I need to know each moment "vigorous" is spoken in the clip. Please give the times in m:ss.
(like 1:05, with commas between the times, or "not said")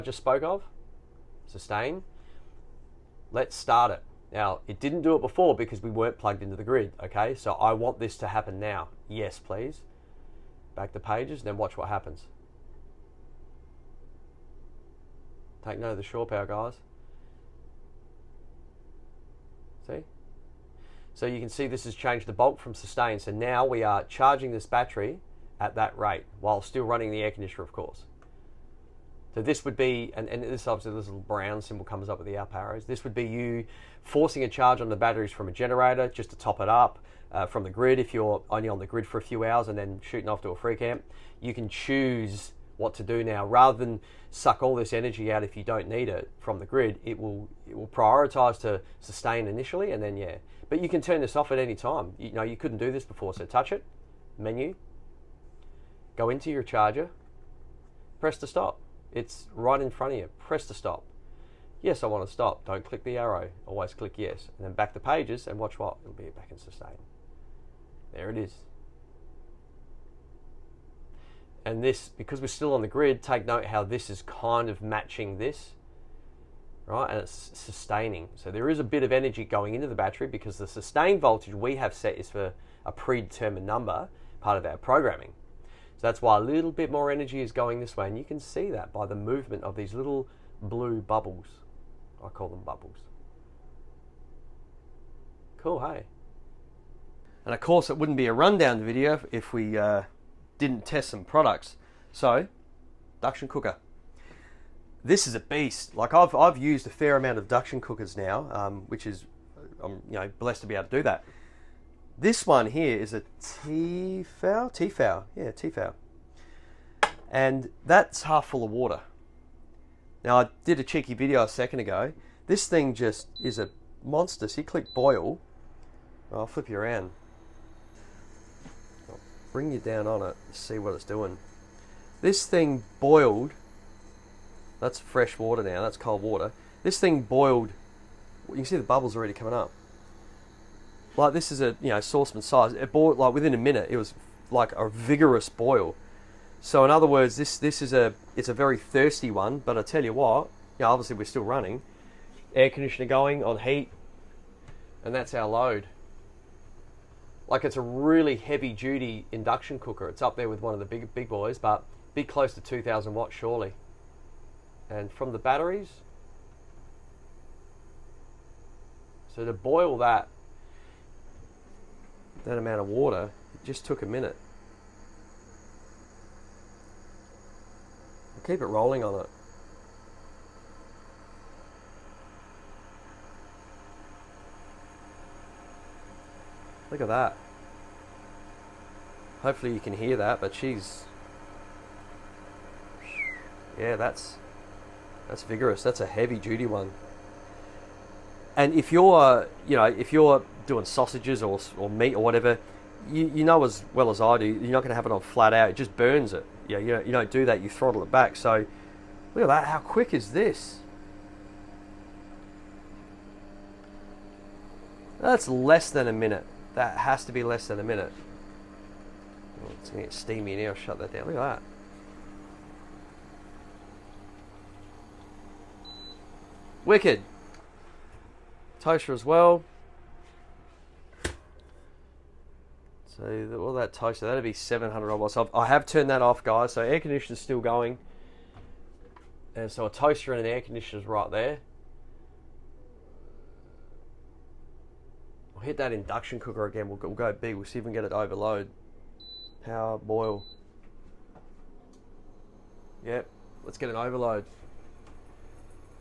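2:24, 3:15.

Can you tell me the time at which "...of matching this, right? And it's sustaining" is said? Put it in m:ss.
1:14.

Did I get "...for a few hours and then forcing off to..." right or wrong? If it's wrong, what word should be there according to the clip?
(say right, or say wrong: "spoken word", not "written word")
wrong: "shooting", not "forcing".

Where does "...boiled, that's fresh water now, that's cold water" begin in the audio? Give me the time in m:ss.
2:12.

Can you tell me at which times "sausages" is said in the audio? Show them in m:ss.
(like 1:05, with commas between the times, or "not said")
3:20.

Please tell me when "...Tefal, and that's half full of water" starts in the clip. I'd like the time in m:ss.
1:55.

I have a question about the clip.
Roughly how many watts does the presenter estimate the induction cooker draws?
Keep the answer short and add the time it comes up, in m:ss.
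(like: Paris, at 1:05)
2,000 watts, at 2:42.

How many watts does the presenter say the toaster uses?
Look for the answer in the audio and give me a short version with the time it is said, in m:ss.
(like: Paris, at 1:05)
700 watts, at 3:54.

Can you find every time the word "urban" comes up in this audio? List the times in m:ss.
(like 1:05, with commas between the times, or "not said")
not said.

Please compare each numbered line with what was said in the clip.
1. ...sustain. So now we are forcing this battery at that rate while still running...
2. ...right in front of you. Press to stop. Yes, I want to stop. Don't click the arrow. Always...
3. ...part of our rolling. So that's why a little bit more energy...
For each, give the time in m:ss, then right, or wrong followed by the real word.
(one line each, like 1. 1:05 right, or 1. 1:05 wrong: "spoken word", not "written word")
1. 0:22 wrong: "charging", not "forcing"
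2. 0:59 right
3. 1:24 wrong: "programming", not "rolling".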